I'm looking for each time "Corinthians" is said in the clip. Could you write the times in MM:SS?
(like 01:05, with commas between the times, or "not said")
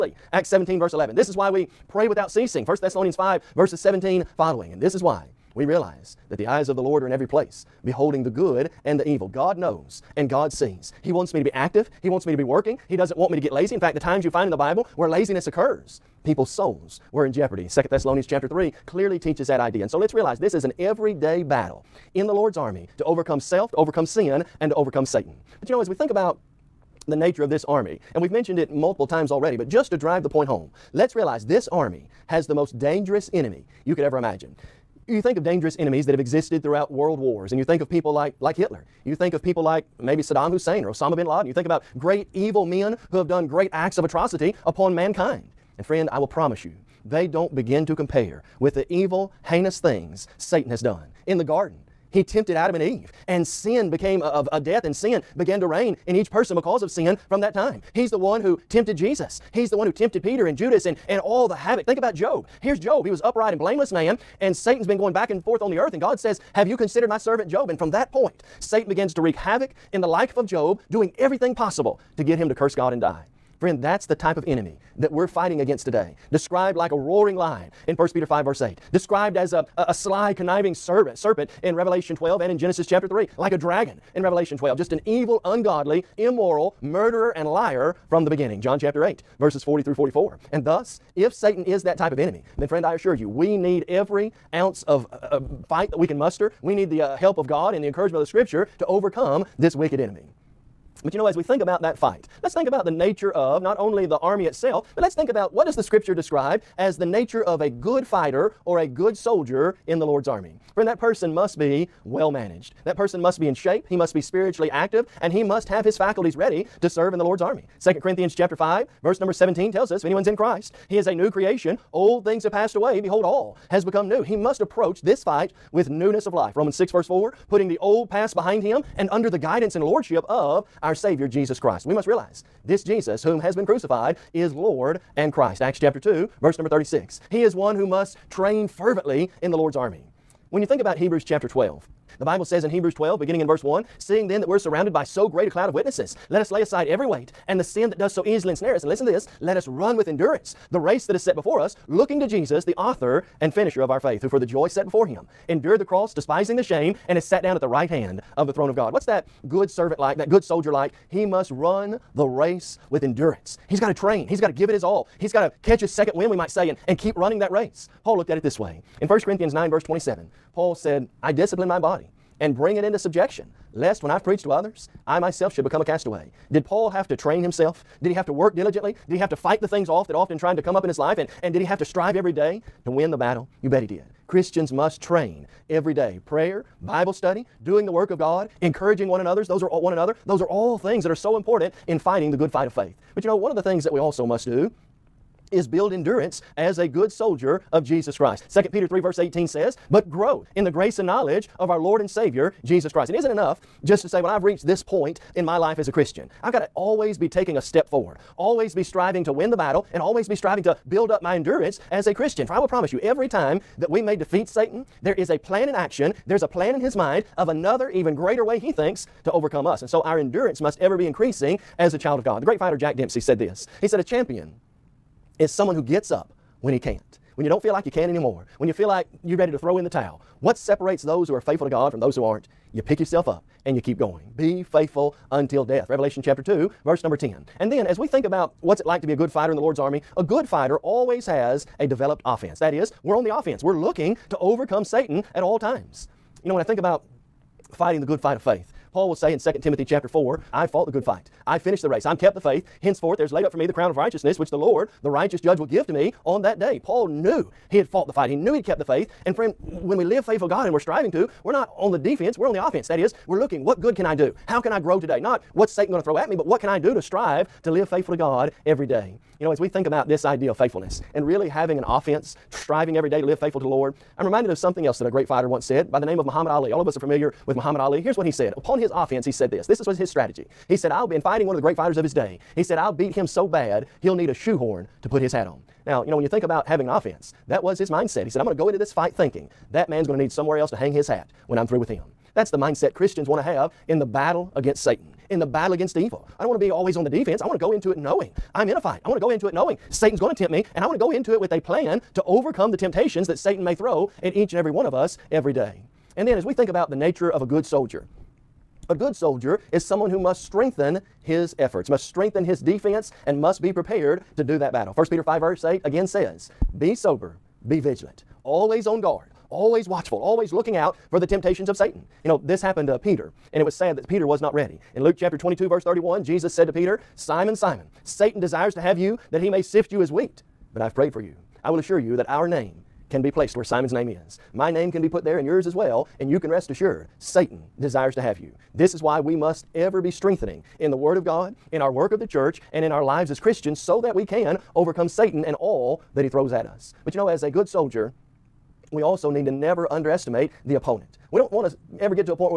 01:57, 02:49.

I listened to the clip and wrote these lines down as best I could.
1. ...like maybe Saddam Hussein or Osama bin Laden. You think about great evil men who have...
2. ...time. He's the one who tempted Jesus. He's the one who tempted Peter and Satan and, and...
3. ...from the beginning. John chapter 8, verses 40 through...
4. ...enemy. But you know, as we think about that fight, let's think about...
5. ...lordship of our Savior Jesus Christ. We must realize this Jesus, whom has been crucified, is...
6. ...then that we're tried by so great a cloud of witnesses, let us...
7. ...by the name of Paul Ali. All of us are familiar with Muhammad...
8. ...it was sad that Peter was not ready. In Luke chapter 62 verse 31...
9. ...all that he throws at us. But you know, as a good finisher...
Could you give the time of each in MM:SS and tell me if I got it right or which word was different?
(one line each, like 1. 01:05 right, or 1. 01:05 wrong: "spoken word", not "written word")
1. 00:39 right
2. 00:57 wrong: "Judas", not "Satan"
3. 01:28 right
4. 01:39 right
5. 02:09 right
6. 02:24 wrong: "surrounded", not "tried"
7. 04:35 wrong: "Muhammad", not "Paul"
8. 05:23 wrong: "22", not "62"
9. 05:45 wrong: "soldier", not "finisher".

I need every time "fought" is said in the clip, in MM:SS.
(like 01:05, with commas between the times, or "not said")
04:10, 04:17.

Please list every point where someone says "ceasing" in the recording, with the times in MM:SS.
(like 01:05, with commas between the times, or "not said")
00:02.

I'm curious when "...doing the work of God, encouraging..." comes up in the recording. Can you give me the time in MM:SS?
03:07.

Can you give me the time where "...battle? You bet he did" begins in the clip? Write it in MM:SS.
03:03.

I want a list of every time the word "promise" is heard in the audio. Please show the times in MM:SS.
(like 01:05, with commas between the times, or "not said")
00:46, 03:32.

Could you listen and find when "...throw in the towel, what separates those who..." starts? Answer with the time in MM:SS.
03:49.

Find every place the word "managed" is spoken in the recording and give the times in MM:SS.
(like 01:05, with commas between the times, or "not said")
01:52.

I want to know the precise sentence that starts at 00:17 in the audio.
2 Thessalonians chapter 3 clearly teaches that idea.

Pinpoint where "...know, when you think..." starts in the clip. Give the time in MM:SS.
04:46.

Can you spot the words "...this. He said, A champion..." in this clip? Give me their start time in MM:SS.
03:43.